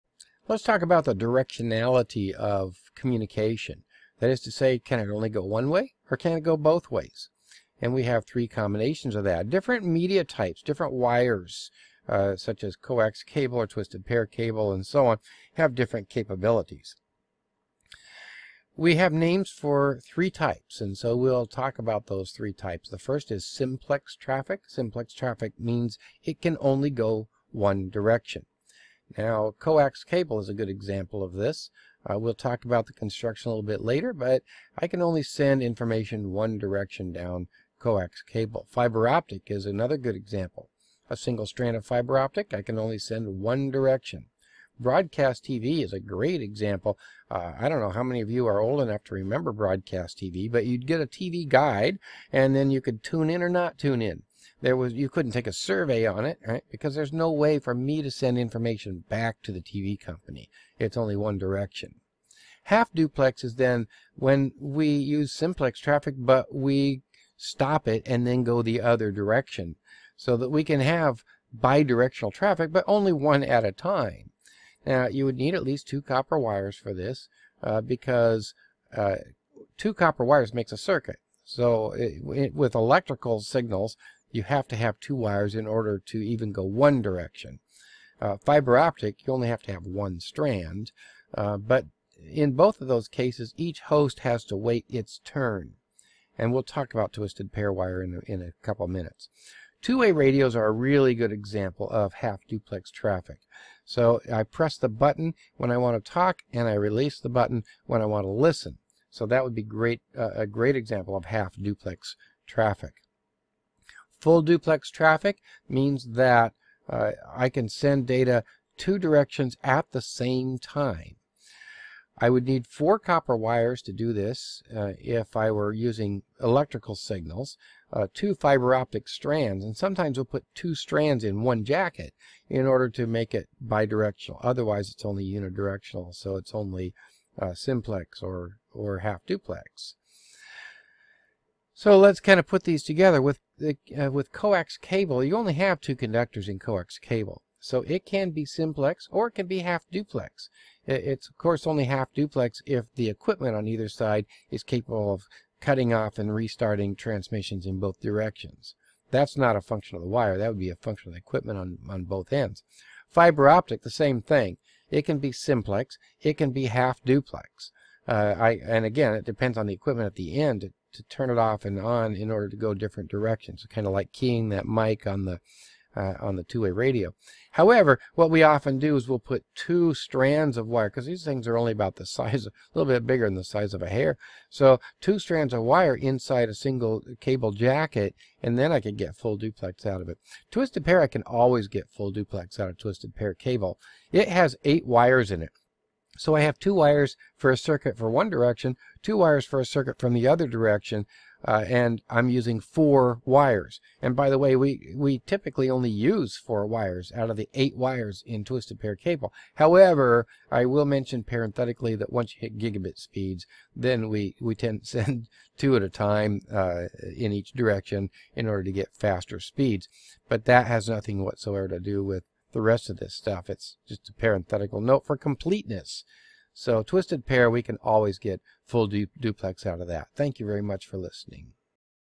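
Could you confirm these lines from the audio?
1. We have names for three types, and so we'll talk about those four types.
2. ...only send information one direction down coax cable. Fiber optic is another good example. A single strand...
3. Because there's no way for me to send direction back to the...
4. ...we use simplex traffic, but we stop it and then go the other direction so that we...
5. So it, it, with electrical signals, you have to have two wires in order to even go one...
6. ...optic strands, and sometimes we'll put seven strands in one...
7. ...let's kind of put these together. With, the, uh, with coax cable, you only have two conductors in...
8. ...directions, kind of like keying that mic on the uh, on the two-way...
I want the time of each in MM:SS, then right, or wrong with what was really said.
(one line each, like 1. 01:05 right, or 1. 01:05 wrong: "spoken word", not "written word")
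1. 00:18 wrong: "three", not "four"
2. 00:35 right
3. 00:56 wrong: "information", not "direction"
4. 01:04 right
5. 01:21 right
6. 02:08 wrong: "two", not "seven"
7. 02:21 right
8. 02:53 right.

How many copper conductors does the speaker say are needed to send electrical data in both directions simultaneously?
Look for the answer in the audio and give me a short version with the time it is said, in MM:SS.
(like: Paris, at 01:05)
4, at 02:02.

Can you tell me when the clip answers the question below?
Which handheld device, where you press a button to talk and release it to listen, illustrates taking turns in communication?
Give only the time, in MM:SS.
01:39.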